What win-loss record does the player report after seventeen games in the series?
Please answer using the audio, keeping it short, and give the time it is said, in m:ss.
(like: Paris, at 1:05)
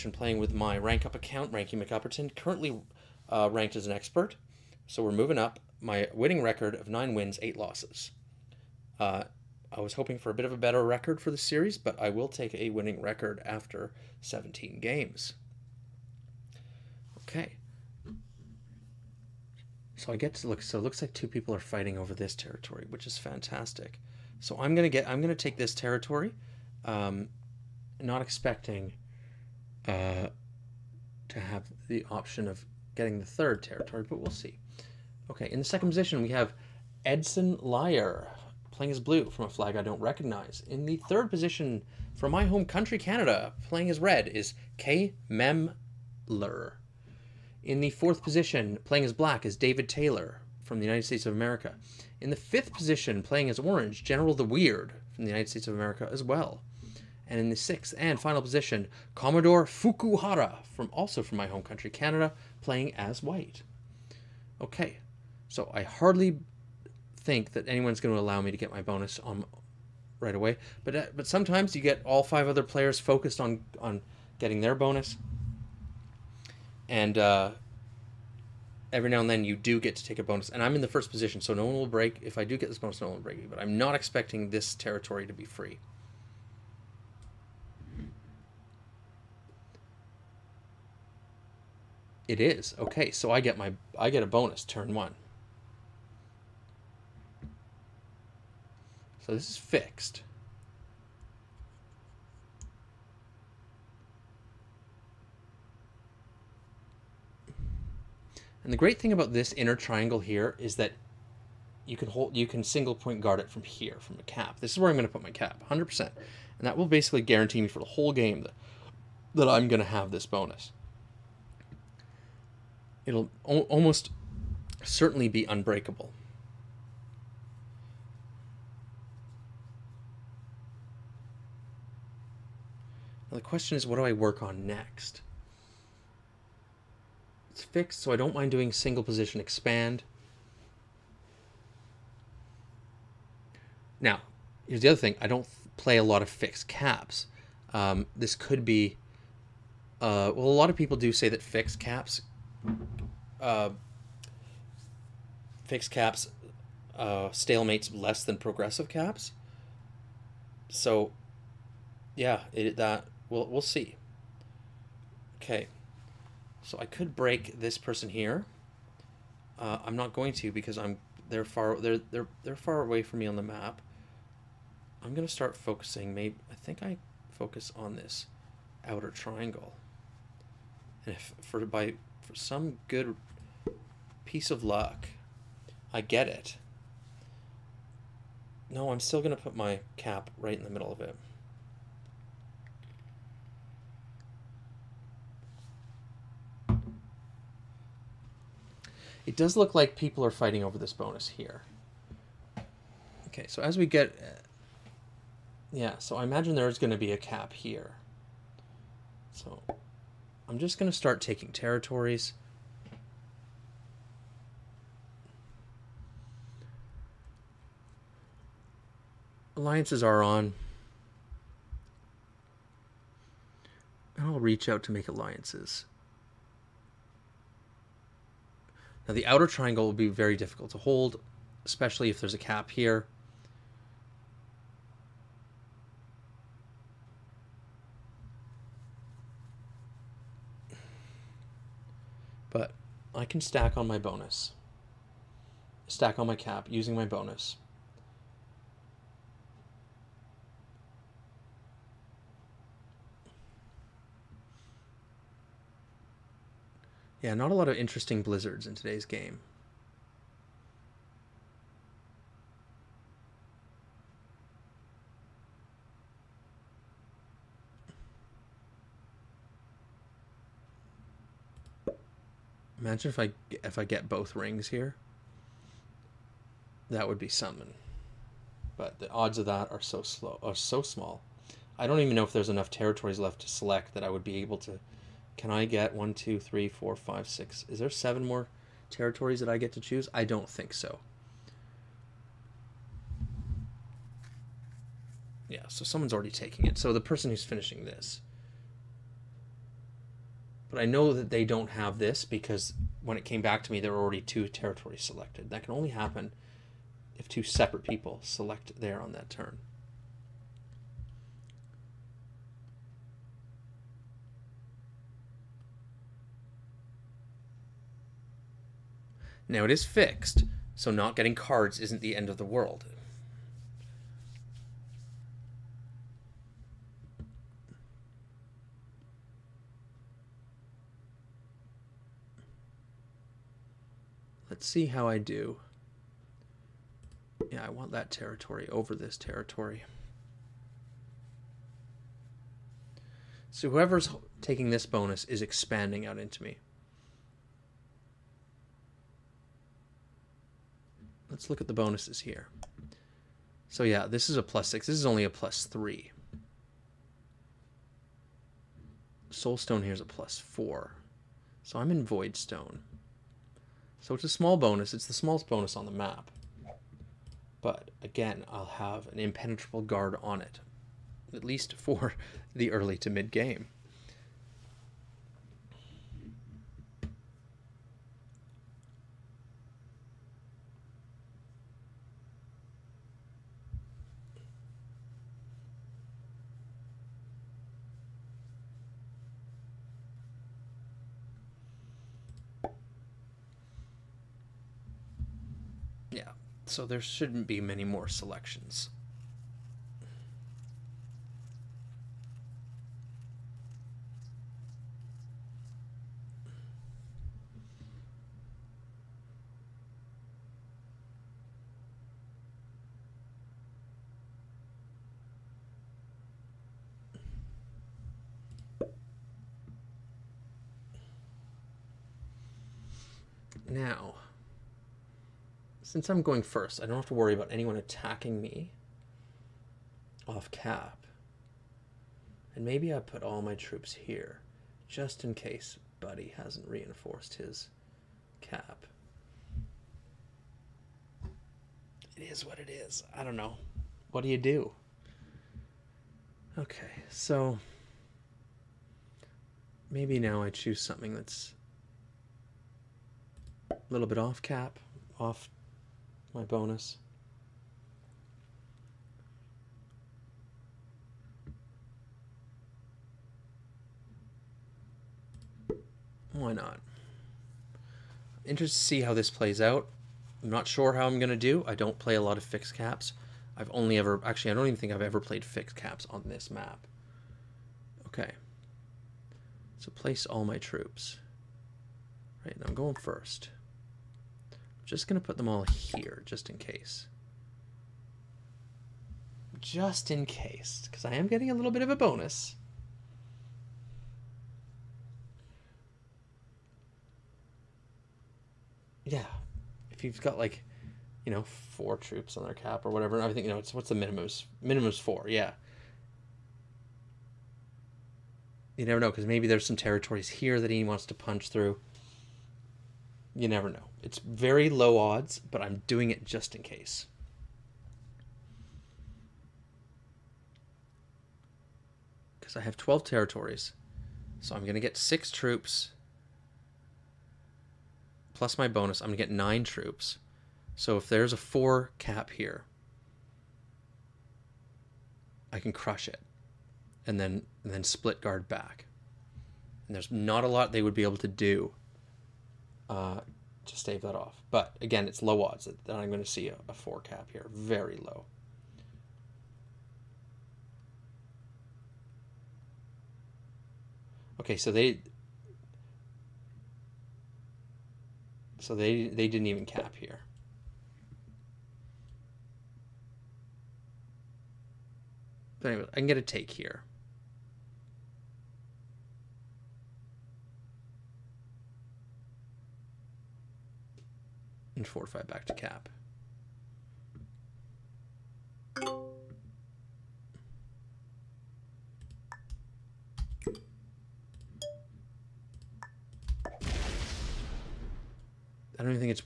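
9 wins, 8 losses, at 0:06.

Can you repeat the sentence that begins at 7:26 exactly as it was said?
Okay, so maybe now I choose something that's a little bit off cap, off my bonus.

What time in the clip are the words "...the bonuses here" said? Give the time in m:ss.
5:51.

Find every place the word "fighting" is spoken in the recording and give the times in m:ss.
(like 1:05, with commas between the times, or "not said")
0:21, 3:20.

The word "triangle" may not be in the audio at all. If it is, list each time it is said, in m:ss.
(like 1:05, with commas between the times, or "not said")
1:49, 2:59, 3:49.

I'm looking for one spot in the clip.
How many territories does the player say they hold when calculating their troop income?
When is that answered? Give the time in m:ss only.
8:42.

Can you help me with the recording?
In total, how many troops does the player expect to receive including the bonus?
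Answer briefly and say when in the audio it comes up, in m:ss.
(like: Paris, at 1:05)
9, at 8:49.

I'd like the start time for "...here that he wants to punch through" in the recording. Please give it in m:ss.
8:30.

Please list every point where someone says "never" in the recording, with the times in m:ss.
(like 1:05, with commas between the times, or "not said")
8:28, 8:33.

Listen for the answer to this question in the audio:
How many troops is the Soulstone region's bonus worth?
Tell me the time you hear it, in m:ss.
6:00.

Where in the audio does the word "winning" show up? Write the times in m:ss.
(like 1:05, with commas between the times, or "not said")
0:06, 0:12.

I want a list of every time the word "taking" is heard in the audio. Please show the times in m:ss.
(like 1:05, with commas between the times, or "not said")
3:31, 4:56, 5:44.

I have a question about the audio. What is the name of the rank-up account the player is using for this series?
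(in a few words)
Ranky McUpperton.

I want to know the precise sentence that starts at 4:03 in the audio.
I can stack on my bonus.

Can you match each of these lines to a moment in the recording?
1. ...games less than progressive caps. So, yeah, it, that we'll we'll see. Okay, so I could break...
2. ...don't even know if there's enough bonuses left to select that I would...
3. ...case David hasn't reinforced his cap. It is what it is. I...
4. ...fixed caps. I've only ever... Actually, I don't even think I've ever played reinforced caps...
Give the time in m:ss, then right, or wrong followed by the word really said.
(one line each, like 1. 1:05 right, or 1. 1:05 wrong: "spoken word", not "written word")
1. 2:37 wrong: "stalemates", not "games"
2. 4:41 wrong: "territories", not "bonuses"
3. 7:15 wrong: "Buddy", not "David"
4. 7:52 wrong: "fixed", not "reinforced".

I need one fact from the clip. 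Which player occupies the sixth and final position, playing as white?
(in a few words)
Commodore Fukuhara.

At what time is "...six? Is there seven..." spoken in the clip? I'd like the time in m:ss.
4:47.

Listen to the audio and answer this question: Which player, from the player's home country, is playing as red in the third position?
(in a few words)
K. Memler.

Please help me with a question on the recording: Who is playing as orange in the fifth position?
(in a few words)
General the Weird.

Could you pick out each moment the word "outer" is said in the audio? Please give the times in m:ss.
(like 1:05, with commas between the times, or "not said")
2:58, 3:49.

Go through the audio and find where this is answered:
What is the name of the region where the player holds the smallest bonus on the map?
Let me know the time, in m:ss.
6:02.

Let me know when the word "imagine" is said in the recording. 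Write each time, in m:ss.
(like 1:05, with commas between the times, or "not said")
3:26, 4:32.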